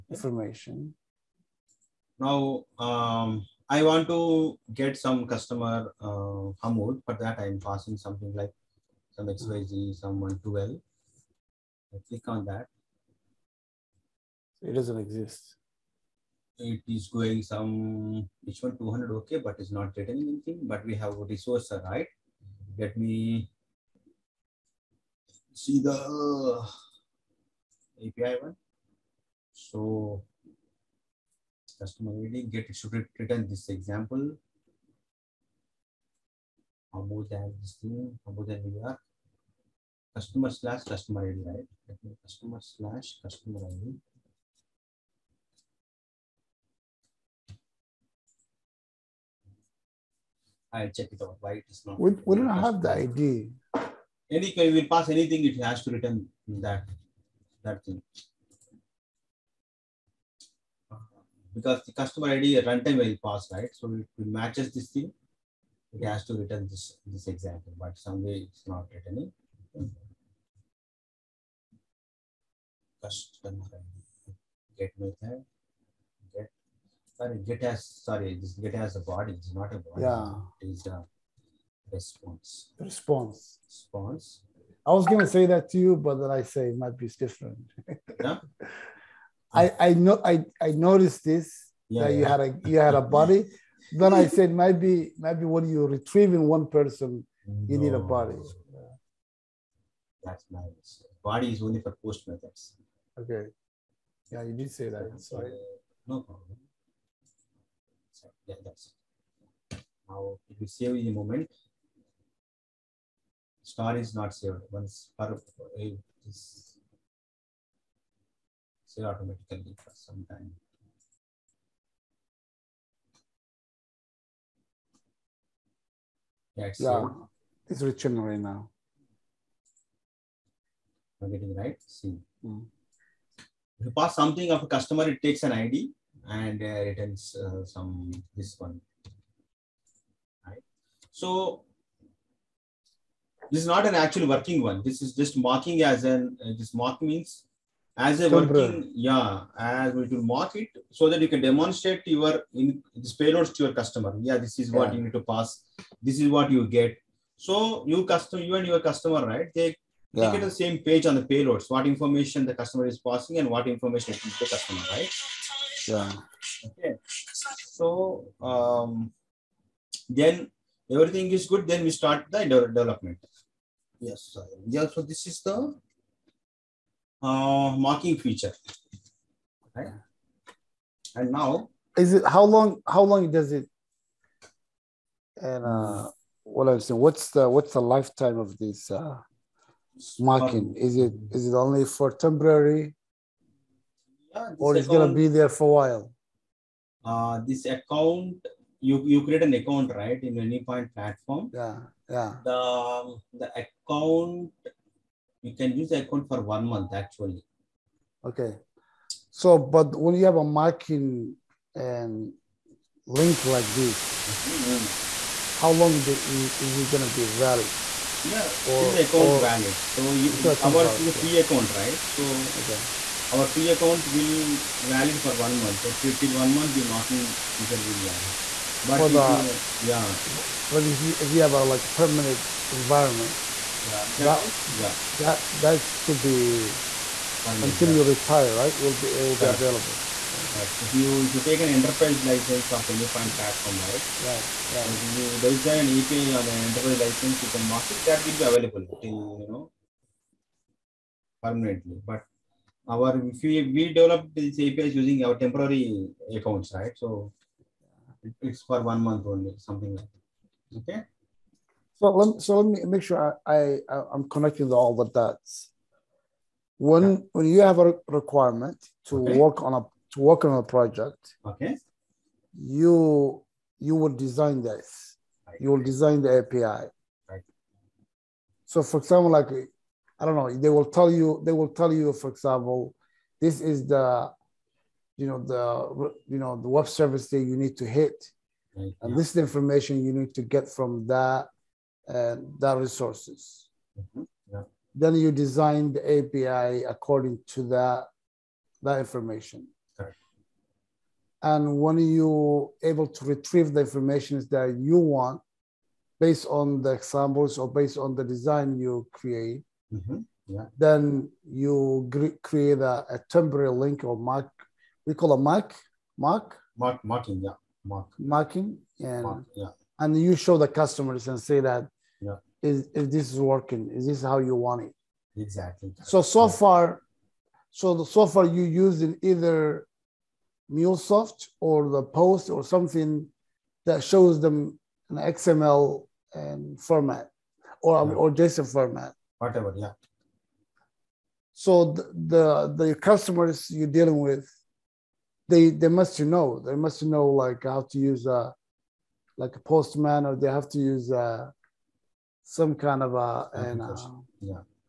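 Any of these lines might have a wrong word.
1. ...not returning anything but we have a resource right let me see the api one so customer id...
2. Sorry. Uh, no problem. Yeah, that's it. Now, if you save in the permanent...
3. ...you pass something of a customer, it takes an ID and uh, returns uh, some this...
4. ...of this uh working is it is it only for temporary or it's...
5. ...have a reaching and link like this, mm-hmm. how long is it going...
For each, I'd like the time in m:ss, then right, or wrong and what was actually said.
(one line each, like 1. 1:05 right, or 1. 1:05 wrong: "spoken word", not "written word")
1. 0:19 right
2. 1:45 wrong: "moment", not "permanent"
3. 2:13 right
4. 3:08 wrong: "marking", not "working"
5. 3:30 wrong: "marking", not "reaching".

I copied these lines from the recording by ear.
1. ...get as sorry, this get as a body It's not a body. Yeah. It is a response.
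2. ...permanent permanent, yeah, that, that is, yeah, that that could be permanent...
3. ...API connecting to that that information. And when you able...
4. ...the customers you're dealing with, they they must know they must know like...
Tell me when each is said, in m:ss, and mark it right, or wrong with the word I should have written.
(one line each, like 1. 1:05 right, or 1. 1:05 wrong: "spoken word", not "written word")
1. 1:17 right
2. 3:52 wrong: "environment", not "permanent"
3. 4:56 wrong: "according", not "connecting"
4. 5:42 right.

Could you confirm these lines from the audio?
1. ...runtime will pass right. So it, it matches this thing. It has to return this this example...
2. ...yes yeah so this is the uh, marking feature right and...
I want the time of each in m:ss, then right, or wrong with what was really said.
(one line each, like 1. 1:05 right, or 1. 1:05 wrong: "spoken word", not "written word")
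1. 1:02 right
2. 2:53 right.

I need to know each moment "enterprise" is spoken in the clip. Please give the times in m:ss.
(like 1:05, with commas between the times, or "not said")
4:01, 4:06.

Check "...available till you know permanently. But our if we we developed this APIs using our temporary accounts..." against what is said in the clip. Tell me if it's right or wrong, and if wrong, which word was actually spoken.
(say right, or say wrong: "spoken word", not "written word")
right.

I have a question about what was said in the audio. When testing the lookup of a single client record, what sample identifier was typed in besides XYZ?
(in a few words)
112.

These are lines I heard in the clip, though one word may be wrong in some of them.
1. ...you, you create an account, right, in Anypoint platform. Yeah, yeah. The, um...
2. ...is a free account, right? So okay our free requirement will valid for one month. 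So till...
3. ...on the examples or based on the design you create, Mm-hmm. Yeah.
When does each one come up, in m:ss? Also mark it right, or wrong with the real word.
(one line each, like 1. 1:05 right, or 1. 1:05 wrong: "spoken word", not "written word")
1. 3:18 right
2. 3:40 wrong: "account", not "requirement"
3. 5:06 right.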